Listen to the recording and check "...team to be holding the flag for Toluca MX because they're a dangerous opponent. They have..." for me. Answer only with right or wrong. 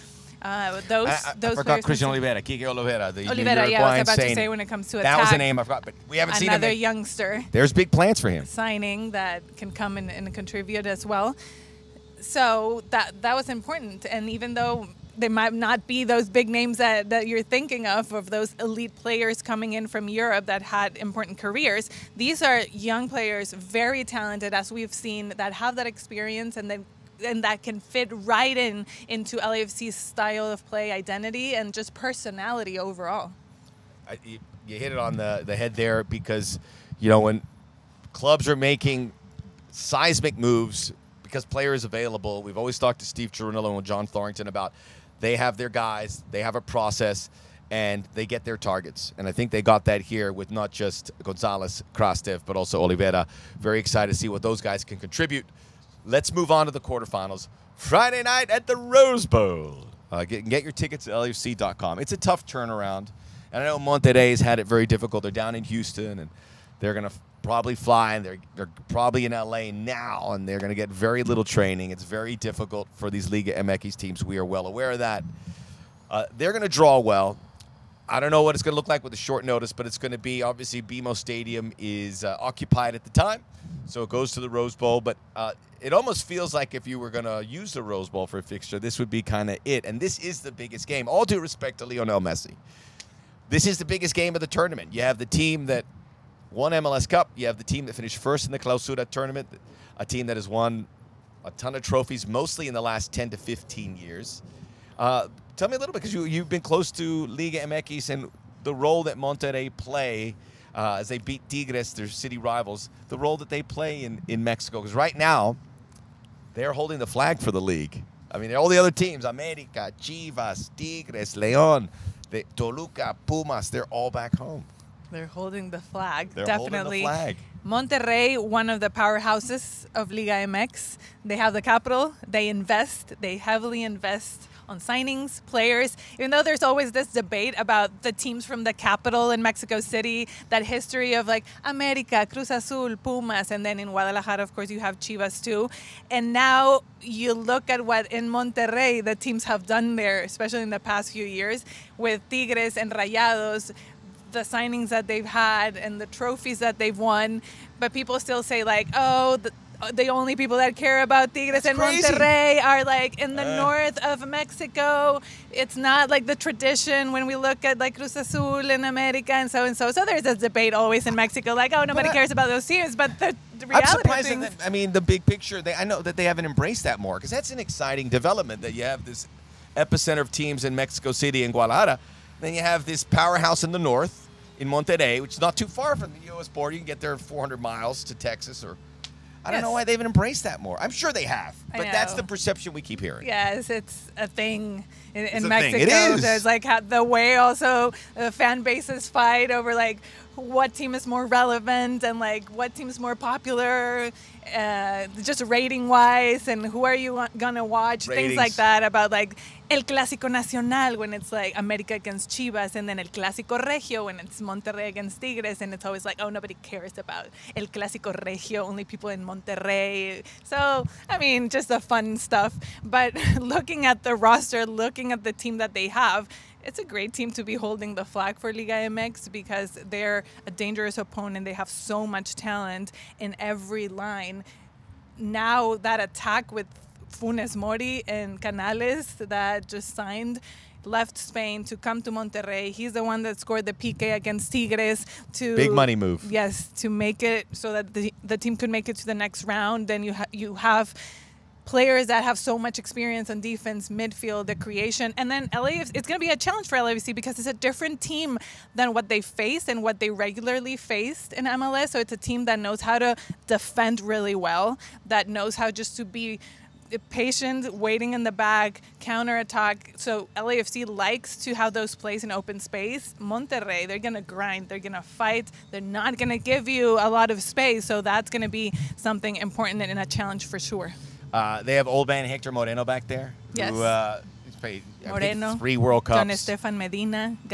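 wrong.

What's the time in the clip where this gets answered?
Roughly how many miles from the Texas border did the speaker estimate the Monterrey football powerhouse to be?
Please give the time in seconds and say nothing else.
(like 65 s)
187 s.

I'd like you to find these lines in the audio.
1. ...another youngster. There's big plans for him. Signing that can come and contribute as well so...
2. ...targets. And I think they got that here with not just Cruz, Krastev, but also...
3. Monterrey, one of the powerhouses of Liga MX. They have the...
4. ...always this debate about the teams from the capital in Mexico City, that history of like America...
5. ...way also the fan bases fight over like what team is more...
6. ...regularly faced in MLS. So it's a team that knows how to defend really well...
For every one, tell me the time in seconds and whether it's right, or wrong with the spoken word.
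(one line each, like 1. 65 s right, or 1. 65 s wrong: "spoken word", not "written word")
1. 6 s right
2. 48 s wrong: "Gonzalez", not "Cruz"
3. 127 s right
4. 136 s right
5. 197 s right
6. 260 s right.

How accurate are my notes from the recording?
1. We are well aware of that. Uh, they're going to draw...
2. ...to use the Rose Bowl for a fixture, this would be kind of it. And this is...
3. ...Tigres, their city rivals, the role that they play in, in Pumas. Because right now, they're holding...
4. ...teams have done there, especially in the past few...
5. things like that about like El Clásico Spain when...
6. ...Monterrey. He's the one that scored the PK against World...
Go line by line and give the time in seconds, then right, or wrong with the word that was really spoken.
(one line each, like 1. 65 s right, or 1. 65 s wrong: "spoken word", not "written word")
1. 74 s right
2. 87 s right
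3. 111 s wrong: "Mexico", not "Pumas"
4. 149 s right
5. 208 s wrong: "Nacional", not "Spain"
6. 242 s wrong: "Tigres", not "World".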